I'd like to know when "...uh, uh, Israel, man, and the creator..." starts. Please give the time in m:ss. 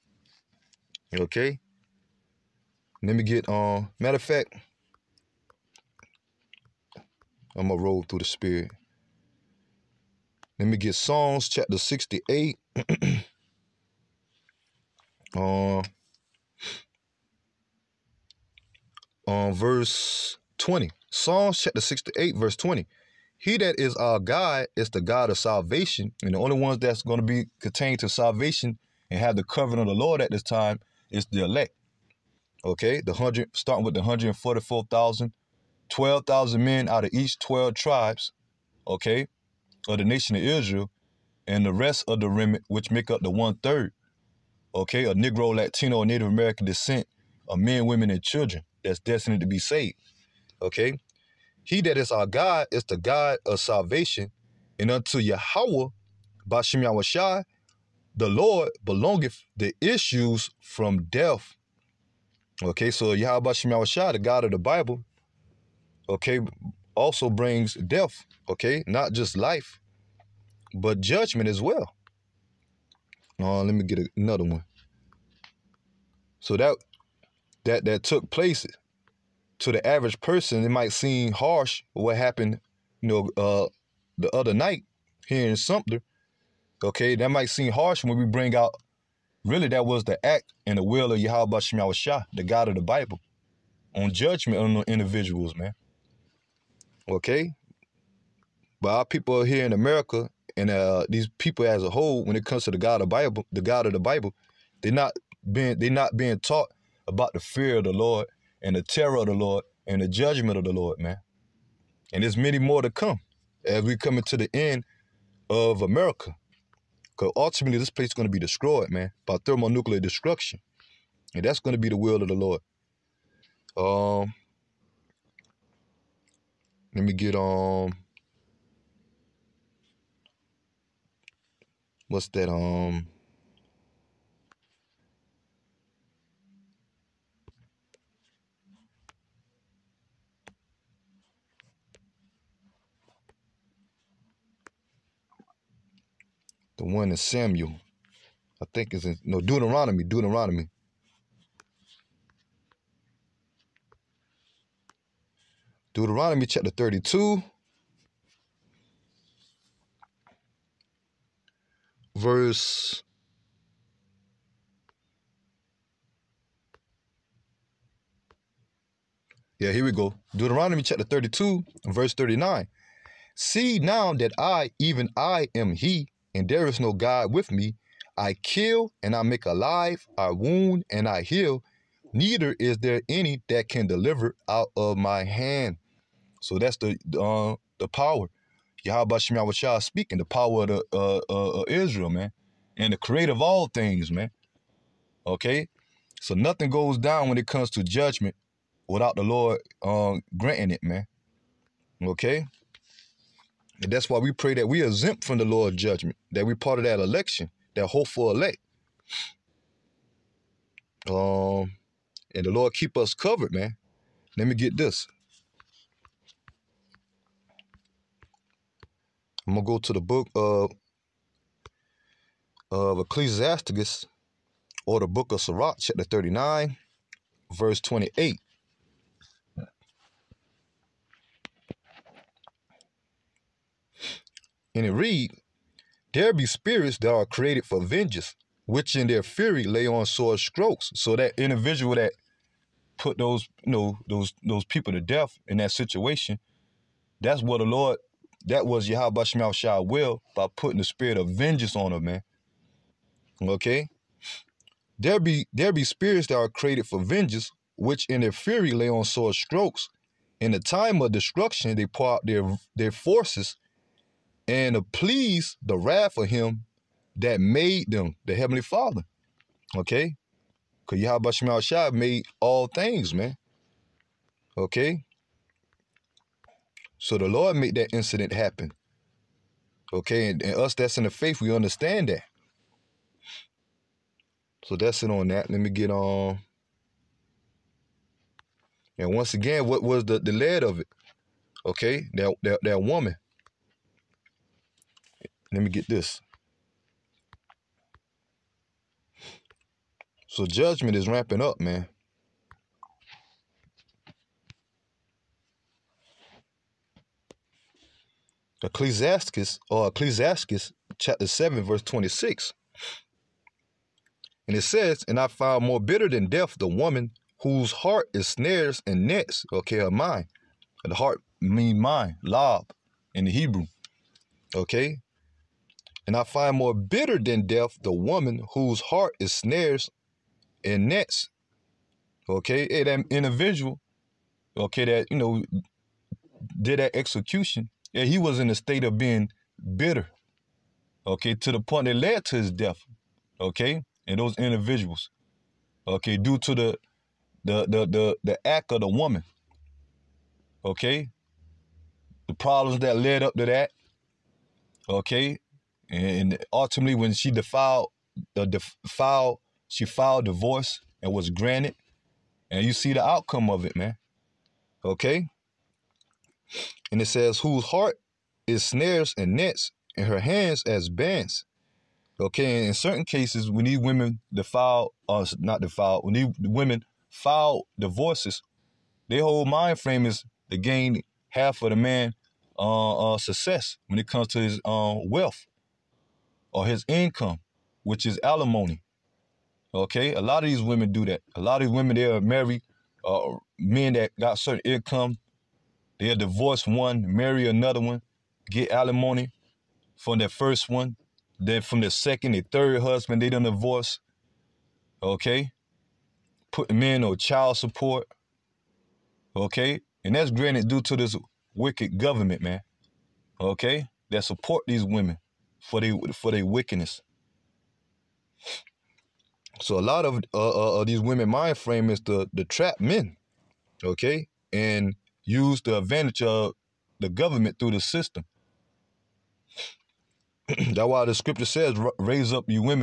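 3:10.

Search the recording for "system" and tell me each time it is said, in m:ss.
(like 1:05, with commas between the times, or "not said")
7:07.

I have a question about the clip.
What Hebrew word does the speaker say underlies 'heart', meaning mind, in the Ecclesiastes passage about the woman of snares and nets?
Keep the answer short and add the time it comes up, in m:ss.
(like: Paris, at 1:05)
lob, at 5:22.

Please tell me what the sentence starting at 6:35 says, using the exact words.
They'll divorce one, marry another one, get alimony from their first one.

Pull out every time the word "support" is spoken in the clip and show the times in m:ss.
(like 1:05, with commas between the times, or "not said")
6:47, 6:54.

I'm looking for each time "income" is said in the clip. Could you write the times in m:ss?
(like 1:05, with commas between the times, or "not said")
6:26, 6:34.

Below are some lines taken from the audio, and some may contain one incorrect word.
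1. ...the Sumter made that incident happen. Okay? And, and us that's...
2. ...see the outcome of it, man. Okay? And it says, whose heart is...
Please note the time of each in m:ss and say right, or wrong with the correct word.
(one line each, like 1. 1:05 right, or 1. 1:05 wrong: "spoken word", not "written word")
1. 4:37 wrong: "Lord", not "Sumter"
2. 6:02 right.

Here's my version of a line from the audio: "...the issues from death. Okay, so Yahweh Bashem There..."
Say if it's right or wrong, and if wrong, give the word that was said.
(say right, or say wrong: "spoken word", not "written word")
wrong: "Yahweh", not "There".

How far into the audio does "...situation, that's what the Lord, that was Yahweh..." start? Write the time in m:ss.
4:05.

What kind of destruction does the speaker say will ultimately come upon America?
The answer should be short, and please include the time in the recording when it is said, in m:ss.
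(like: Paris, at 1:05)
thermonuclear, at 1:59.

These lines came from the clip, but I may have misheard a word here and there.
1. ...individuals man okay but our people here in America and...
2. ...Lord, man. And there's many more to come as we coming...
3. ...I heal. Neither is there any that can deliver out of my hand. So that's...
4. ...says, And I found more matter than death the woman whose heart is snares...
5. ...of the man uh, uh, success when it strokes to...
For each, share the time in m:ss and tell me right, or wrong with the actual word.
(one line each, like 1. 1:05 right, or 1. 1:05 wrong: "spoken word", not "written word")
1. 1:34 right
2. 1:50 right
3. 3:01 right
4. 5:14 wrong: "bitter", not "matter"
5. 6:21 wrong: "comes", not "strokes".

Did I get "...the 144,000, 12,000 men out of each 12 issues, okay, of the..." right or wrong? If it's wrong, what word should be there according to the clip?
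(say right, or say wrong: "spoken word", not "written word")
wrong: "tribes", not "issues".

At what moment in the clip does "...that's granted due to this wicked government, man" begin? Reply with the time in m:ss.
6:50.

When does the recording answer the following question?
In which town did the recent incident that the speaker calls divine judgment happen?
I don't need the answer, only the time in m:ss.
1:25.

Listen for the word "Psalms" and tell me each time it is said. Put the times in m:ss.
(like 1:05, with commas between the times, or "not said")
0:10, 0:21.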